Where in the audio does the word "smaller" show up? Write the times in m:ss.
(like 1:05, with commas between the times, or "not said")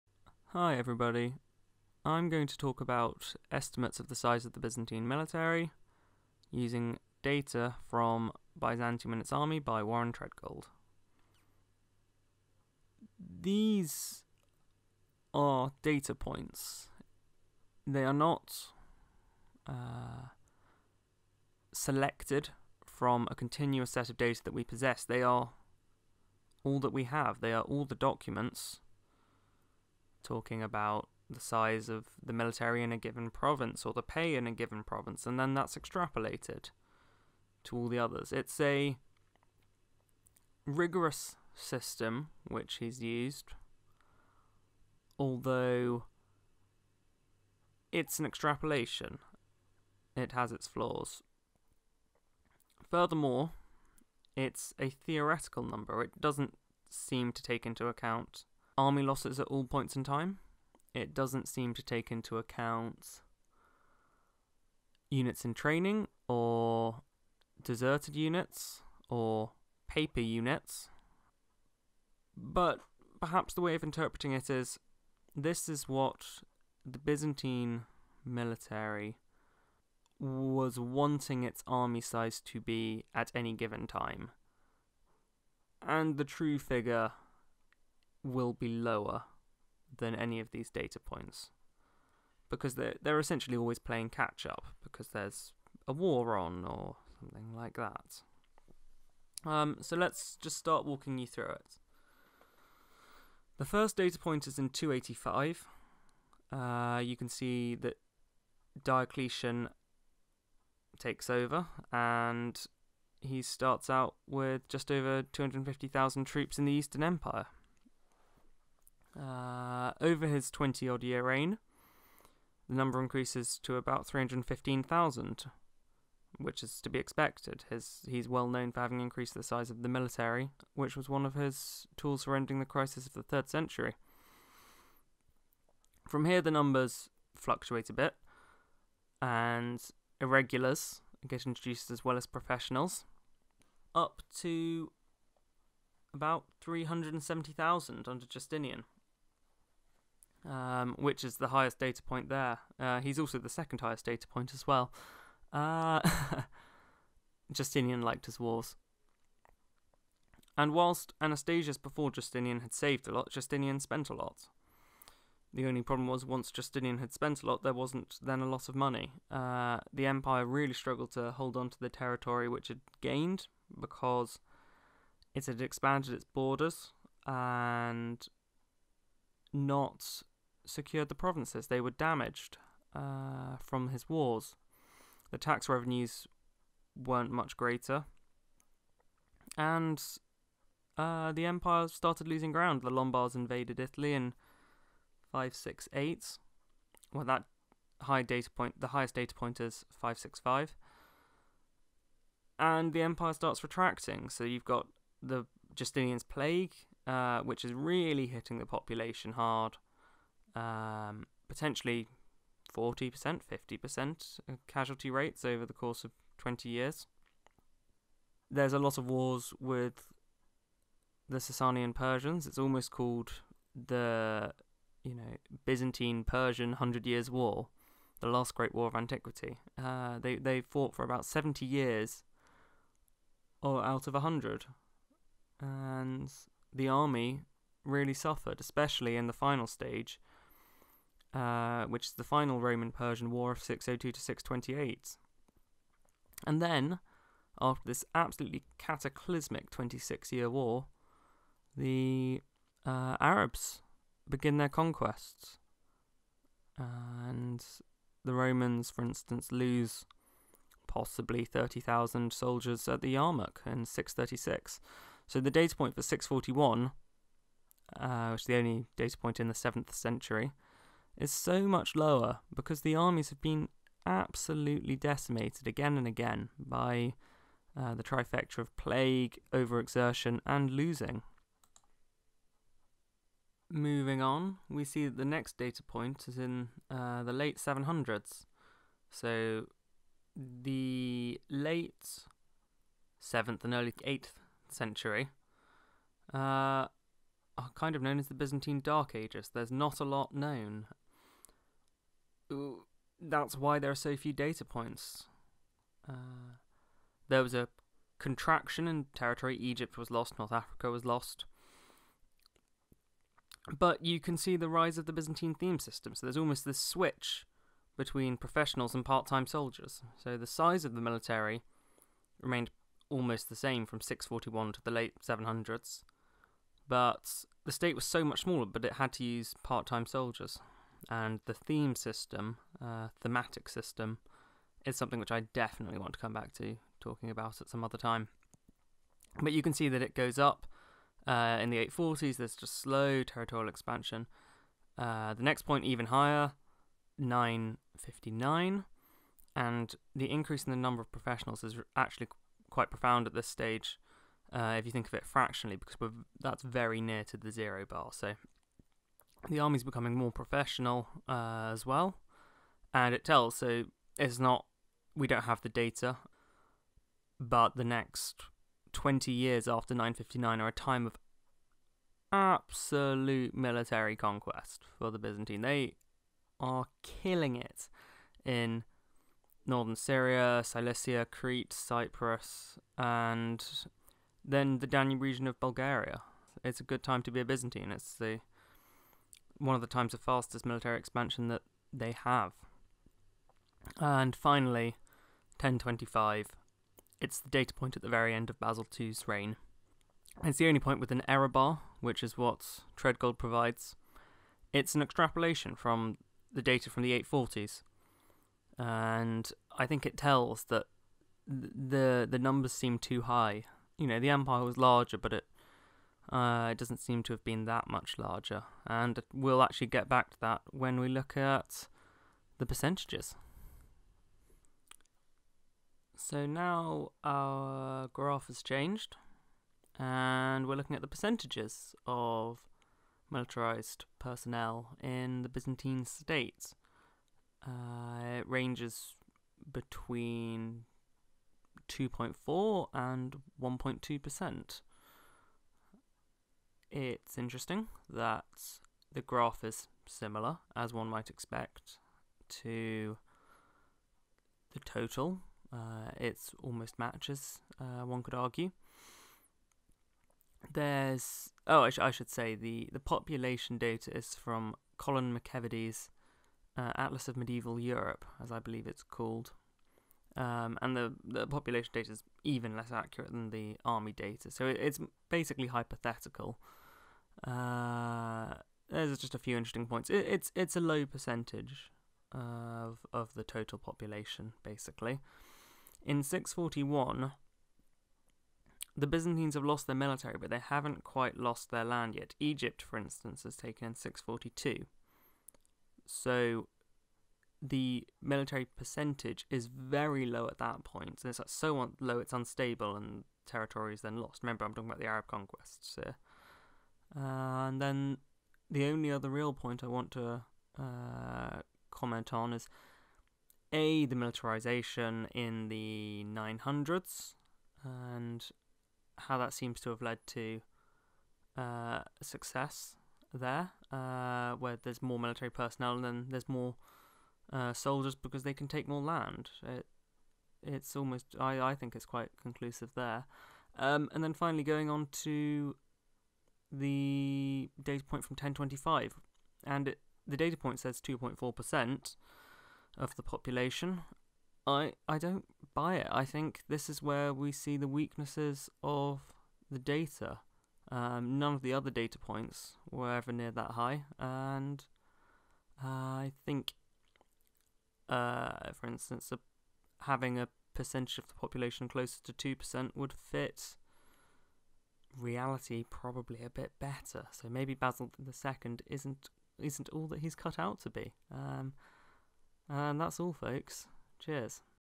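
5:28.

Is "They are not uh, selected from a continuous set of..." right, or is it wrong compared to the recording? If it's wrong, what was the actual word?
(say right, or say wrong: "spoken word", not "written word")
right.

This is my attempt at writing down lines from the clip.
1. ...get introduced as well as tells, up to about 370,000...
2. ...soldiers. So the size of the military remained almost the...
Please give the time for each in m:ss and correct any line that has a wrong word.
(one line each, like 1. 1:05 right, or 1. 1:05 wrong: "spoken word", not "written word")
1. 2:21 wrong: "professionals", not "tells"
2. 5:19 right.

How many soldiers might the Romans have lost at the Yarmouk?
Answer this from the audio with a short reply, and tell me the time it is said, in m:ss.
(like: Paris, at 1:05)
30,000, at 4:21.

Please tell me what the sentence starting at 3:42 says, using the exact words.
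It's almost called the, you know, Byzantine Persian Hundred Years' War, the last great war of antiquity.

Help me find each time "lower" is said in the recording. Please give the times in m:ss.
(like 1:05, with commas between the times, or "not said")
1:28, 4:31.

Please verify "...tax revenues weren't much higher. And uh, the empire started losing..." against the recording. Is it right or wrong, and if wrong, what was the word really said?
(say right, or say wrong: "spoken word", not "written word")
wrong: "greater", not "higher".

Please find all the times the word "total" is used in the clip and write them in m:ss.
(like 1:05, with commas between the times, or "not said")
7:34, 8:03.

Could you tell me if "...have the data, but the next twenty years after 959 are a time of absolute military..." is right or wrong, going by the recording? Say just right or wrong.
right.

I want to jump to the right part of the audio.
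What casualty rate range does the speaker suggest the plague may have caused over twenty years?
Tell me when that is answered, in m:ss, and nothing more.
3:32.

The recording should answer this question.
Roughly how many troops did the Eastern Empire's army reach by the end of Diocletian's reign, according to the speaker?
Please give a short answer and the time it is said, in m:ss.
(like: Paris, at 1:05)
315,000, at 2:04.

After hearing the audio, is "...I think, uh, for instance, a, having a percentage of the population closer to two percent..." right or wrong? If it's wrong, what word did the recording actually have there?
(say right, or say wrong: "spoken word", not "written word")
right.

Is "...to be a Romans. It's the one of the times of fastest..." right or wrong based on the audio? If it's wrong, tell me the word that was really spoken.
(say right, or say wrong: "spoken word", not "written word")
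wrong: "Byzantine", not "Romans".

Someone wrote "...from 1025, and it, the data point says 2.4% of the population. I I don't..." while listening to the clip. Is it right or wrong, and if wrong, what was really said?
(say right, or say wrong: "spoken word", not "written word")
right.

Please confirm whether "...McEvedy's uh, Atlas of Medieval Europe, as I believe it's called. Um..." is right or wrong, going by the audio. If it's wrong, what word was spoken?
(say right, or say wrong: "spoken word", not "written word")
right.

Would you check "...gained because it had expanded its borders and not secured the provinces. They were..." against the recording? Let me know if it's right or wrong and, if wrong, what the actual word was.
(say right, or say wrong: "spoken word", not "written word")
right.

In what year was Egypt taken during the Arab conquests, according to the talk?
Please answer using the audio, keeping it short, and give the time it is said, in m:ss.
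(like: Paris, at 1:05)
642, at 8:13.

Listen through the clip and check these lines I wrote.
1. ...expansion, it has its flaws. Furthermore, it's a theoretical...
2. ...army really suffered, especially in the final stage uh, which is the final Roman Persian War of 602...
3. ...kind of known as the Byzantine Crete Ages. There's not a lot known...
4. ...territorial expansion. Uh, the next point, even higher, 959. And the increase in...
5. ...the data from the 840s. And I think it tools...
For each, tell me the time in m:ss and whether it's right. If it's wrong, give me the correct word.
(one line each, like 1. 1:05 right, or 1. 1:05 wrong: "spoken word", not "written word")
1. 0:48 wrong: "extrapolation", not "expansion"
2. 3:56 right
3. 4:57 wrong: "Dark", not "Crete"
4. 5:43 right
5. 6:46 wrong: "tells", not "tools".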